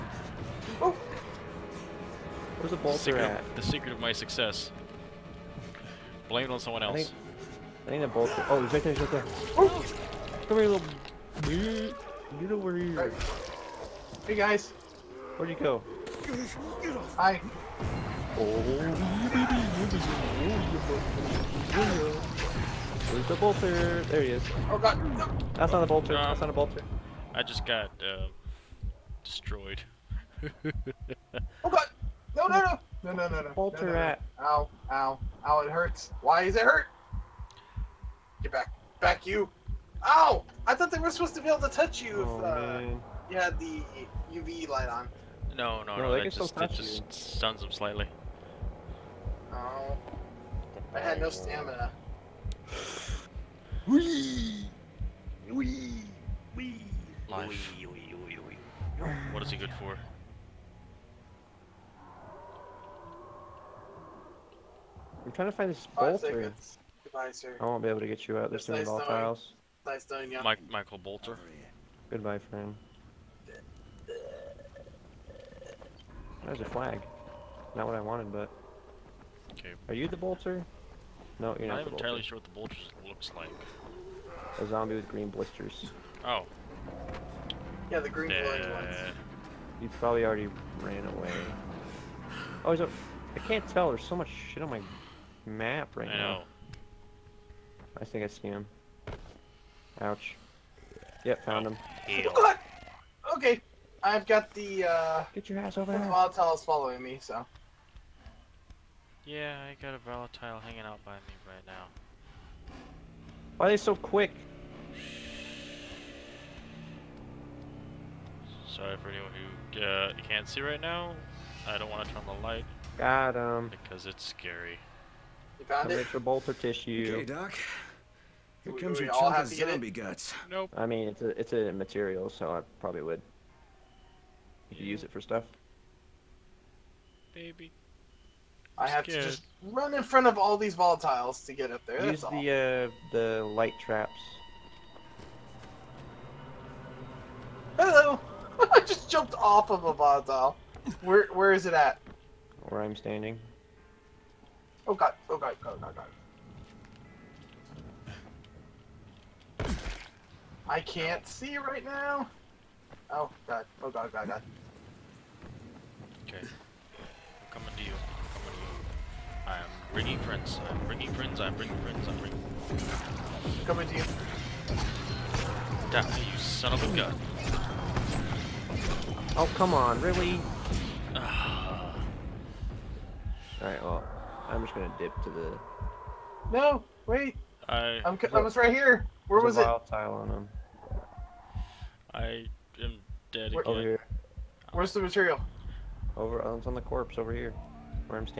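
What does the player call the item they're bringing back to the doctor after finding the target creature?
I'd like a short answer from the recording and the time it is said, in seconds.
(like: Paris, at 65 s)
chunk of zombie guts, at 129 s.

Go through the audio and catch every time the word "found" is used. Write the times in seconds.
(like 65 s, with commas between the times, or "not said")
101 s, 125 s.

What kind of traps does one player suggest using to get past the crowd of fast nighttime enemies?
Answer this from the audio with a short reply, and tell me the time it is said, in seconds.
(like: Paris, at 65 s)
light traps, at 143 s.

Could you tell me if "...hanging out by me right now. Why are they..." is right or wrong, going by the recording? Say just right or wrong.
right.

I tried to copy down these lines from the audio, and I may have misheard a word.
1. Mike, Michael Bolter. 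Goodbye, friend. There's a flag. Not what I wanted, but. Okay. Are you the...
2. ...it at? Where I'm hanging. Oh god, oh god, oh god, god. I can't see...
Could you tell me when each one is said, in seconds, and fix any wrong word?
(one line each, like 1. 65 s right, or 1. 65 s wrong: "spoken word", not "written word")
1. 70 s right
2. 151 s wrong: "standing", not "hanging".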